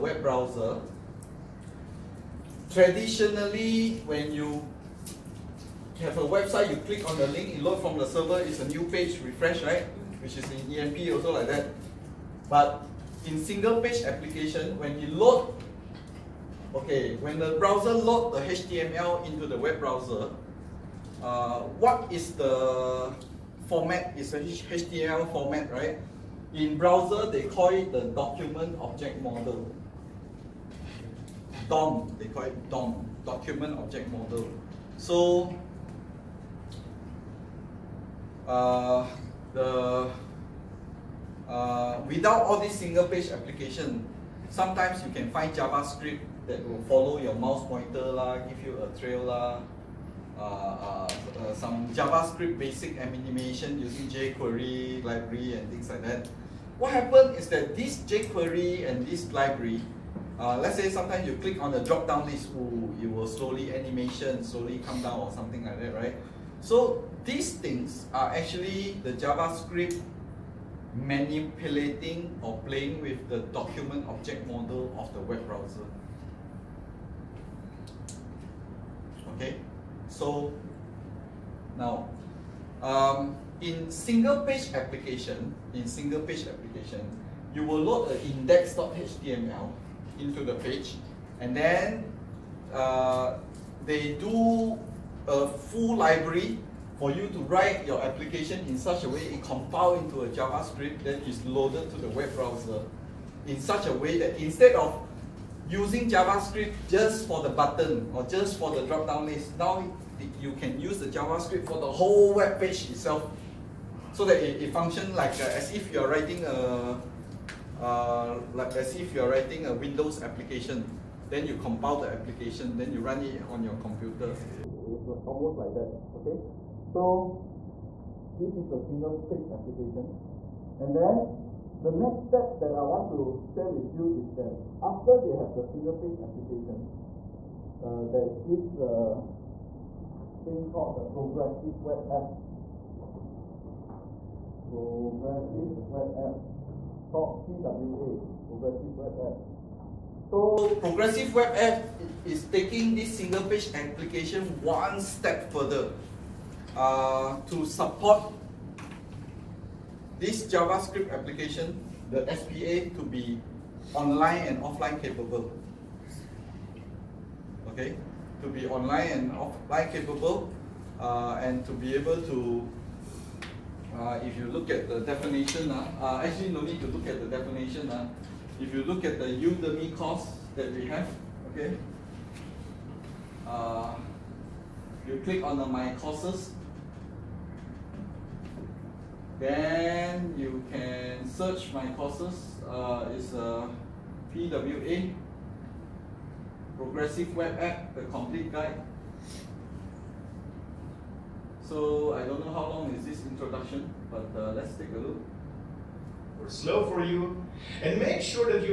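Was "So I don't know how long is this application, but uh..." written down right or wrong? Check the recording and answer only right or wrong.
wrong.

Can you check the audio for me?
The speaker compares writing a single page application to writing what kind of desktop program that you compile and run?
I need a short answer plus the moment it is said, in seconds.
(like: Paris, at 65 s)
Windows application, at 119 s.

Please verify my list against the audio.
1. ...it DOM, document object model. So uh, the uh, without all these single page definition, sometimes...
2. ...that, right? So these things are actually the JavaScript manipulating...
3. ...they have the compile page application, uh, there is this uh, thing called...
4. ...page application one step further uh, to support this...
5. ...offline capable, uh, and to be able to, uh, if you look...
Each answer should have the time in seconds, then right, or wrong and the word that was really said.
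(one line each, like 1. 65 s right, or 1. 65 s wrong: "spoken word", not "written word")
1. 32 s wrong: "application", not "definition"
2. 65 s right
3. 135 s wrong: "single", not "compile"
4. 153 s right
5. 169 s right.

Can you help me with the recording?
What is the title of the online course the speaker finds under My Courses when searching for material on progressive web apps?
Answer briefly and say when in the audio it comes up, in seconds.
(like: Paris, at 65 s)
PWA, Progressive Web App, the complete guide, at 194 s.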